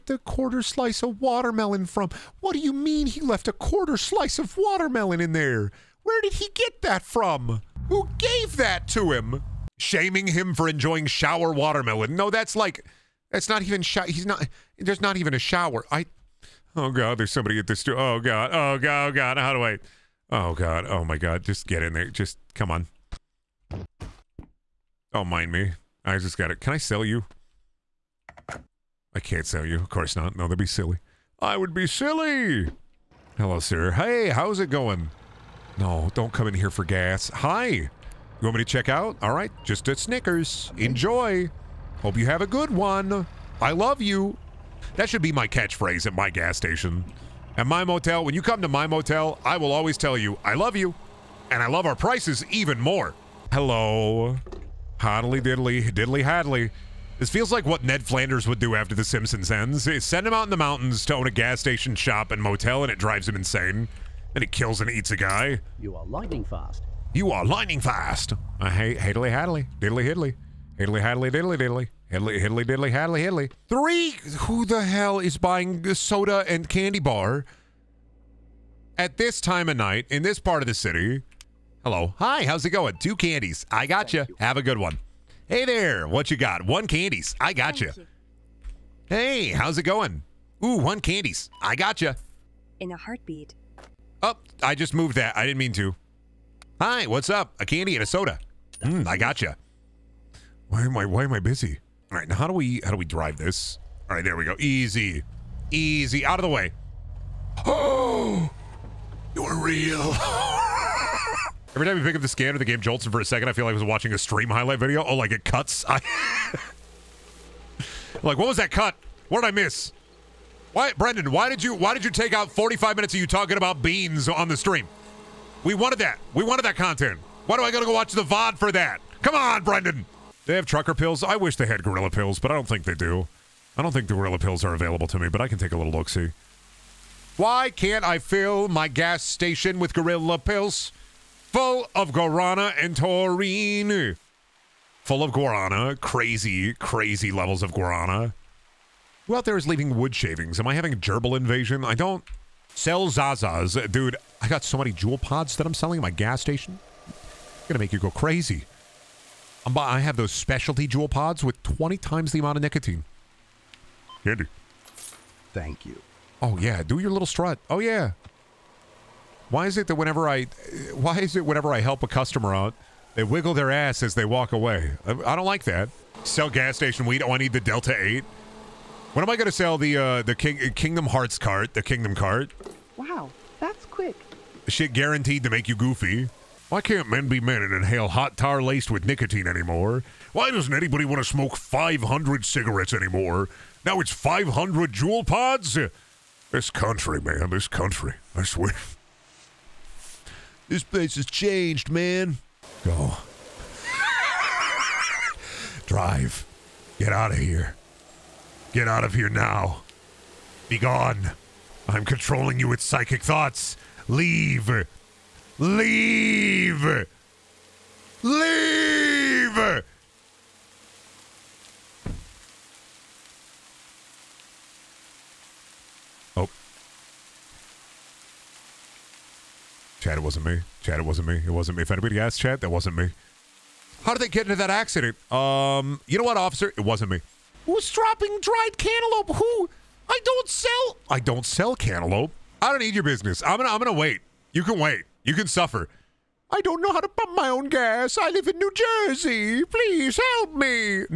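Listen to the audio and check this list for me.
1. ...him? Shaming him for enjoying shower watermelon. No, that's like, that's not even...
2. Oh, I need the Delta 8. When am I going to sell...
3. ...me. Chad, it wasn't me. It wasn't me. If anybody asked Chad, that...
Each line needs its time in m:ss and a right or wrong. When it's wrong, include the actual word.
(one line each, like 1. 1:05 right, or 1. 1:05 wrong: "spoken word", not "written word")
1. 0:09 right
2. 2:57 right
3. 3:50 right.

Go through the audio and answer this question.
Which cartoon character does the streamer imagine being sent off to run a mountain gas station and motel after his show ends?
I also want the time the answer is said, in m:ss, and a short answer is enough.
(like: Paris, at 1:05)
Ned Flanders, at 0:57.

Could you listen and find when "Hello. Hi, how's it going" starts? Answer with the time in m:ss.
1:21.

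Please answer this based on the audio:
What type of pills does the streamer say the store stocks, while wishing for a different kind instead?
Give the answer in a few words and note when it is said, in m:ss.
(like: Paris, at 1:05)
trucker pills, at 2:10.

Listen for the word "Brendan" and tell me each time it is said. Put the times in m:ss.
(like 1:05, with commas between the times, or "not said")
2:00, 2:09.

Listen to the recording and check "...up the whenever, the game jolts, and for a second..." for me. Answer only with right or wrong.
wrong.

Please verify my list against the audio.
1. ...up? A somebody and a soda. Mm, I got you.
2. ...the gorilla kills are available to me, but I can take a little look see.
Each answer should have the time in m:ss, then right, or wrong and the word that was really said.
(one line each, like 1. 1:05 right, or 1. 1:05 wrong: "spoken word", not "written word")
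1. 1:37 wrong: "candy", not "somebody"
2. 2:14 wrong: "pills", not "kills".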